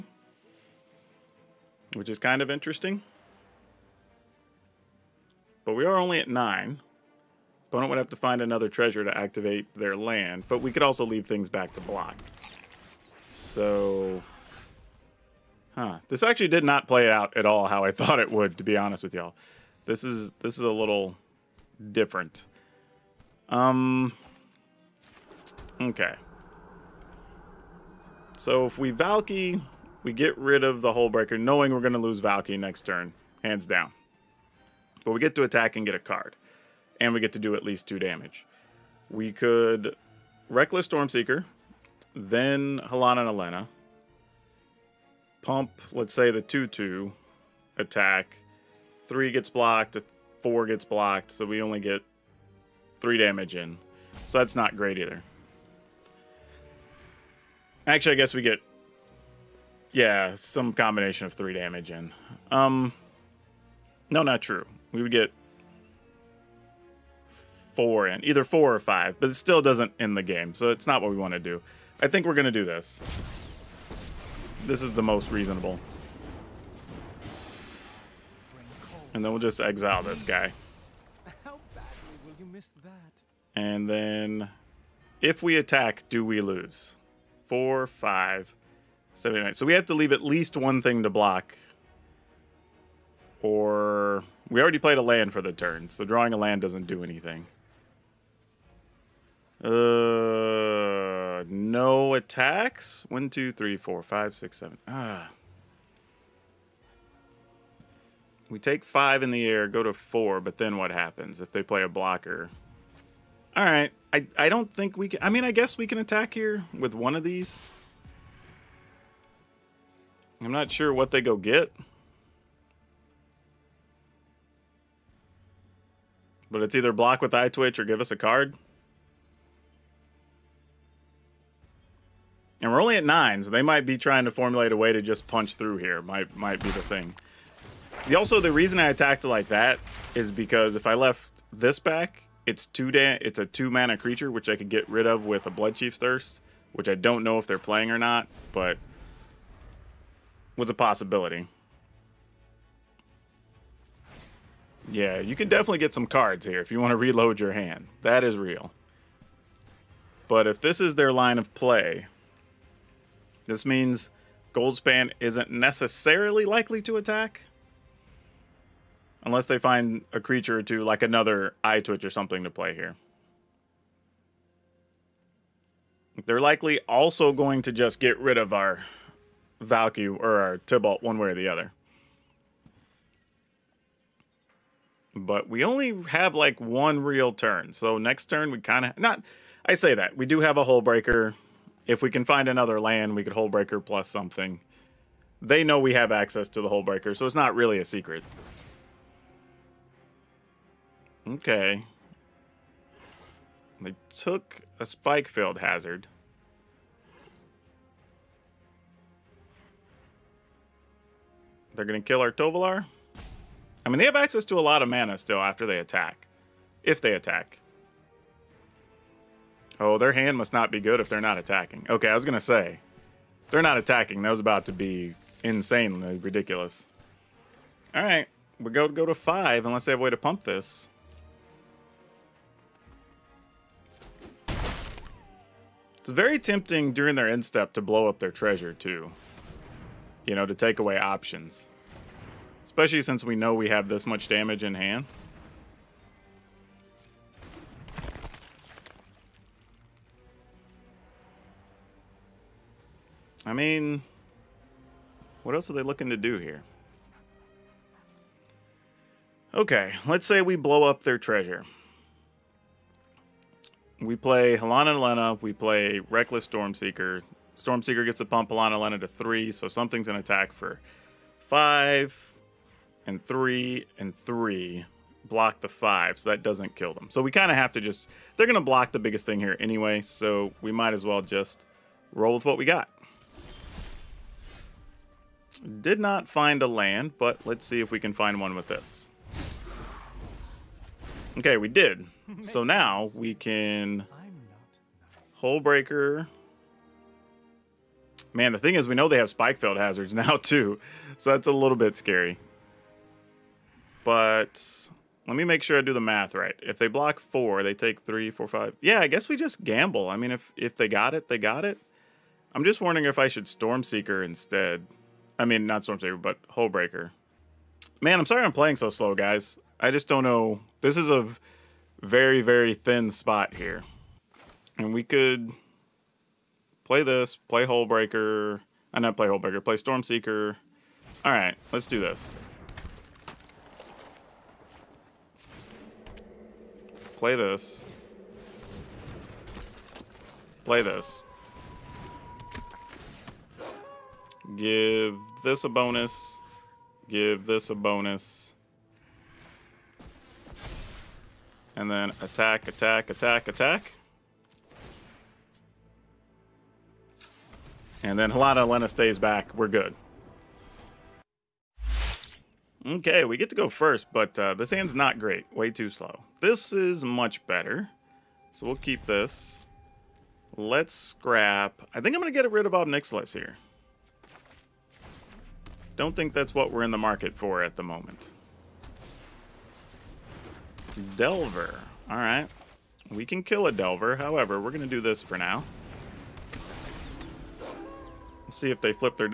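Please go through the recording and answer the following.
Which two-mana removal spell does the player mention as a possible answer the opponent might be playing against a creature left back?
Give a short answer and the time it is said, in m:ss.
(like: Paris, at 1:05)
Blood Chief's Thirst, at 2:25.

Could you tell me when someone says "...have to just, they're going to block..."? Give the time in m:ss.
4:37.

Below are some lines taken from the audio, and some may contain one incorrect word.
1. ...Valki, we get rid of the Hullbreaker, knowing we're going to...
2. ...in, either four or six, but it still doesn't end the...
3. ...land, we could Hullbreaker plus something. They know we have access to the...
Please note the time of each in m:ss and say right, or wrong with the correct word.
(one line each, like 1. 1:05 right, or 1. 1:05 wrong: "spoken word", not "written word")
1. 0:28 right
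2. 1:08 wrong: "five", not "six"
3. 3:12 right.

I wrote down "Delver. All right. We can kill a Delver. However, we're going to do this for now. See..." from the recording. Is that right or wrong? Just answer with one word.
right.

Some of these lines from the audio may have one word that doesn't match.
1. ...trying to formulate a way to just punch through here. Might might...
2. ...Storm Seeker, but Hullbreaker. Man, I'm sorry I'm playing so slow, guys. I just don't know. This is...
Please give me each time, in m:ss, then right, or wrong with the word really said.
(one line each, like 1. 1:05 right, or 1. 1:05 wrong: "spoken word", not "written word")
1. 2:13 right
2. 5:15 right.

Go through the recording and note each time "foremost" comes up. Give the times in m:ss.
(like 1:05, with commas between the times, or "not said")
not said.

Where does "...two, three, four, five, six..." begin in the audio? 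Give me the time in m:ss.
1:43.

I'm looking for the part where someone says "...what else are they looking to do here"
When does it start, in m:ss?
4:15.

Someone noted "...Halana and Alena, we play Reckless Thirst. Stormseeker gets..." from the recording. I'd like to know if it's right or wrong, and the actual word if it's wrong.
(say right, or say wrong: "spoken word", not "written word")
wrong: "Stormseeker", not "Thirst".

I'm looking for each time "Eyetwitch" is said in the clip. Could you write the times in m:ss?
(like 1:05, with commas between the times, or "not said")
2:07, 2:51.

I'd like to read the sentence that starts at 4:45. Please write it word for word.
Did not find a land, but let's see if we can find one with this.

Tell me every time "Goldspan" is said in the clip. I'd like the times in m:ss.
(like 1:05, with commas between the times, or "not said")
2:44.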